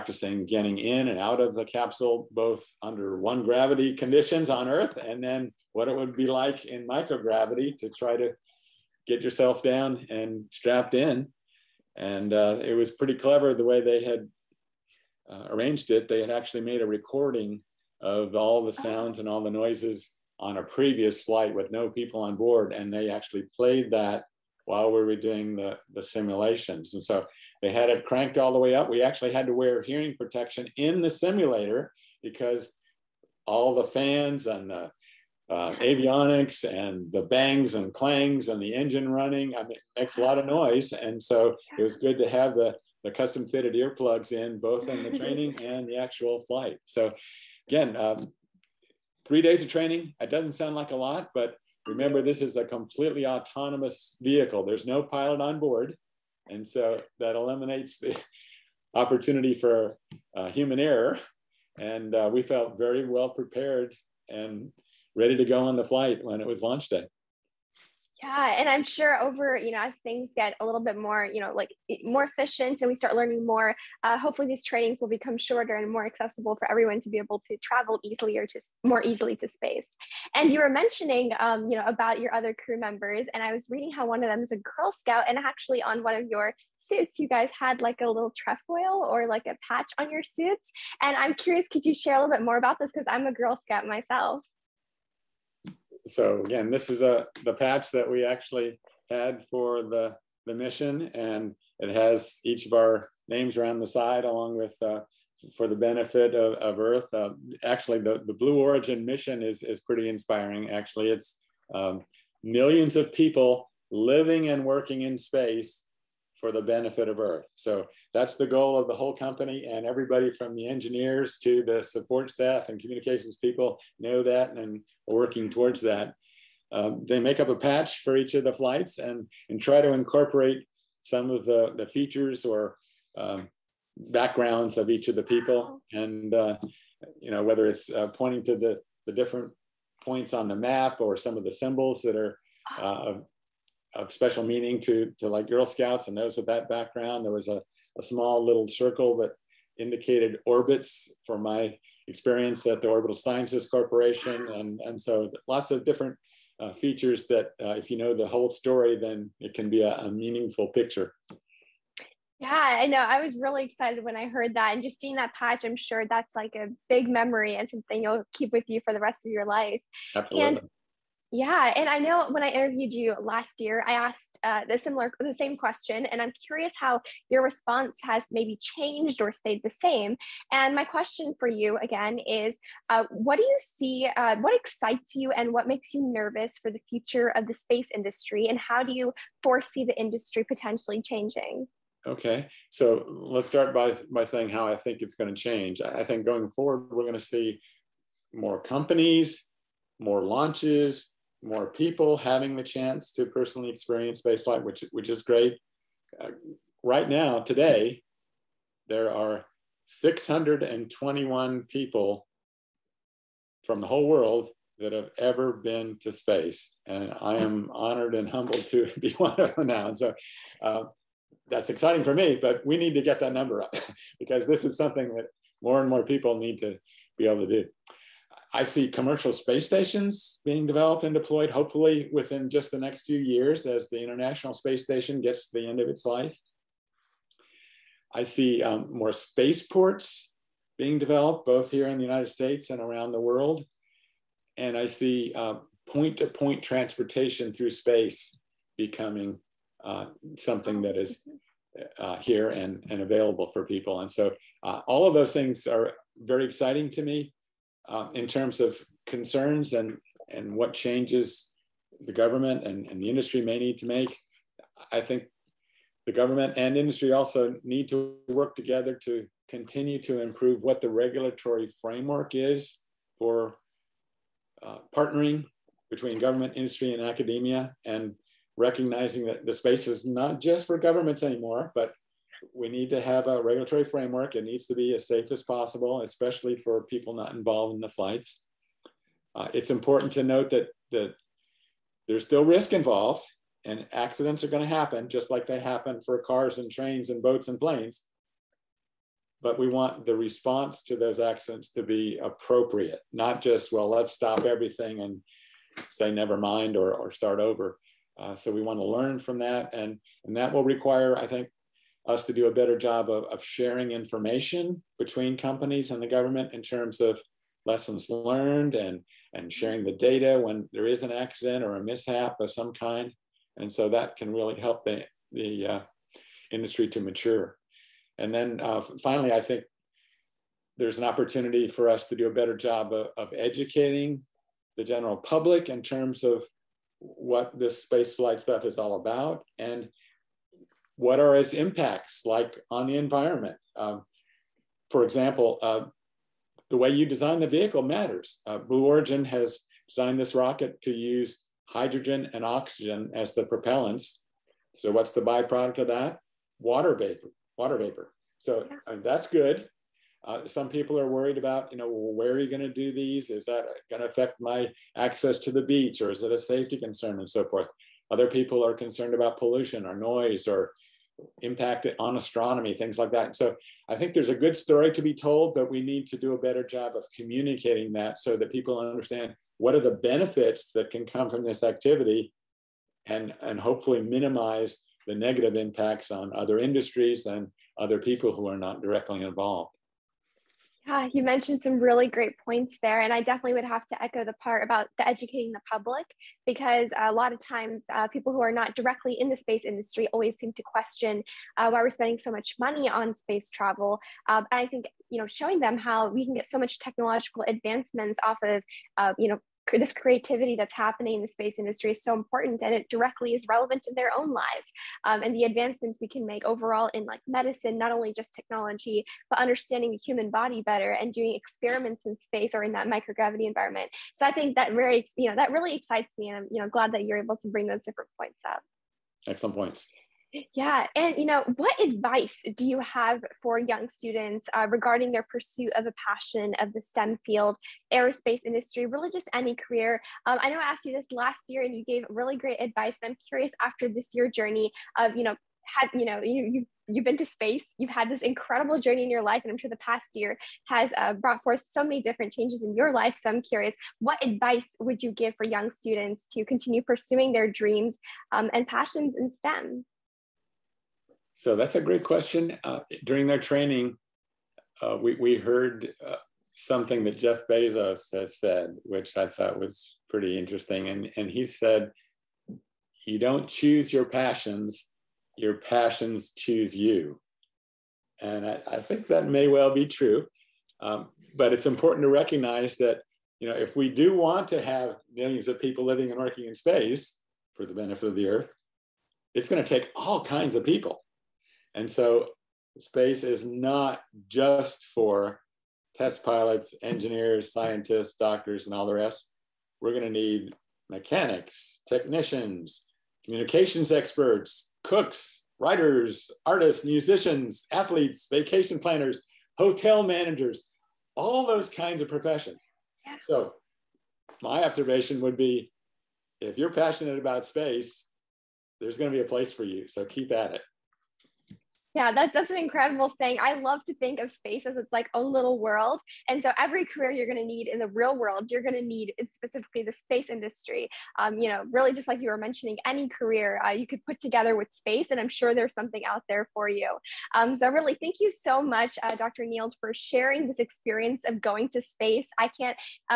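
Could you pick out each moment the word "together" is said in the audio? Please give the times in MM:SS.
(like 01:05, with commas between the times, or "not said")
04:28, 08:54.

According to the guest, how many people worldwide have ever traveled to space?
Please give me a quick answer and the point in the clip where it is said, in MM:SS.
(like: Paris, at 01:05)
621, at 03:29.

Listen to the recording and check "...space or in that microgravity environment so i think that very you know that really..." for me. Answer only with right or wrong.
right.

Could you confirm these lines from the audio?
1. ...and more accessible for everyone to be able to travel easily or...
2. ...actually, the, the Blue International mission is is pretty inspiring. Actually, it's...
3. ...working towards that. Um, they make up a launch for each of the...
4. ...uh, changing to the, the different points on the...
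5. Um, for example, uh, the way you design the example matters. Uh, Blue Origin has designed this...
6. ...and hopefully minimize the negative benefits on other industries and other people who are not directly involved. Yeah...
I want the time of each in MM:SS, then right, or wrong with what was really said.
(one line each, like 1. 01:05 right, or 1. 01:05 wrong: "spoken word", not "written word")
1. 01:15 right
2. 01:47 wrong: "Origin", not "International"
3. 02:05 wrong: "patch", not "launch"
4. 02:17 wrong: "pointing", not "changing"
5. 05:43 wrong: "vehicle", not "example"
6. 06:23 wrong: "impacts", not "benefits".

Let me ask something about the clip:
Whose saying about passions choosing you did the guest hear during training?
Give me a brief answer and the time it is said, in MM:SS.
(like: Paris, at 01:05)
Jeff Bezos, at 07:47.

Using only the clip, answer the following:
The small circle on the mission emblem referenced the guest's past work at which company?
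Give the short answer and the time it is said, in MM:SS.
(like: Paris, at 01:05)
Orbital Sciences Corporation, at 02:32.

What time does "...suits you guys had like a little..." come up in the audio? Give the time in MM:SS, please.
01:26.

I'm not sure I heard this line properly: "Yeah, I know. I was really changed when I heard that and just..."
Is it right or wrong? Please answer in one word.
wrong.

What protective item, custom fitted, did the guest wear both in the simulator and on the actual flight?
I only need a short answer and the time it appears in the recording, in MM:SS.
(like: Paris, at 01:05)
Earplugs, at 00:43.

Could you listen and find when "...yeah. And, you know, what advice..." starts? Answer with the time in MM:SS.
07:10.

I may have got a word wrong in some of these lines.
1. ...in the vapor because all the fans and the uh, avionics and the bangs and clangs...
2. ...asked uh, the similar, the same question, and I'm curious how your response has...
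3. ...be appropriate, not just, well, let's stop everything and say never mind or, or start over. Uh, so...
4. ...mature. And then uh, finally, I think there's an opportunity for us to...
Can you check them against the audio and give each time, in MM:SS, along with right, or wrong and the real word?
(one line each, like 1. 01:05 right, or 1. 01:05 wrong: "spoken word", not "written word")
1. 00:30 wrong: "simulator", not "vapor"
2. 02:53 right
3. 05:01 right
4. 05:27 right.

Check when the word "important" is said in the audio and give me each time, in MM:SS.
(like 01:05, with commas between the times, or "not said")
04:49, 06:52, 08:01.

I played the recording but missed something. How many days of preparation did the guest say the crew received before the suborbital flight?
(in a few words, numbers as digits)
3.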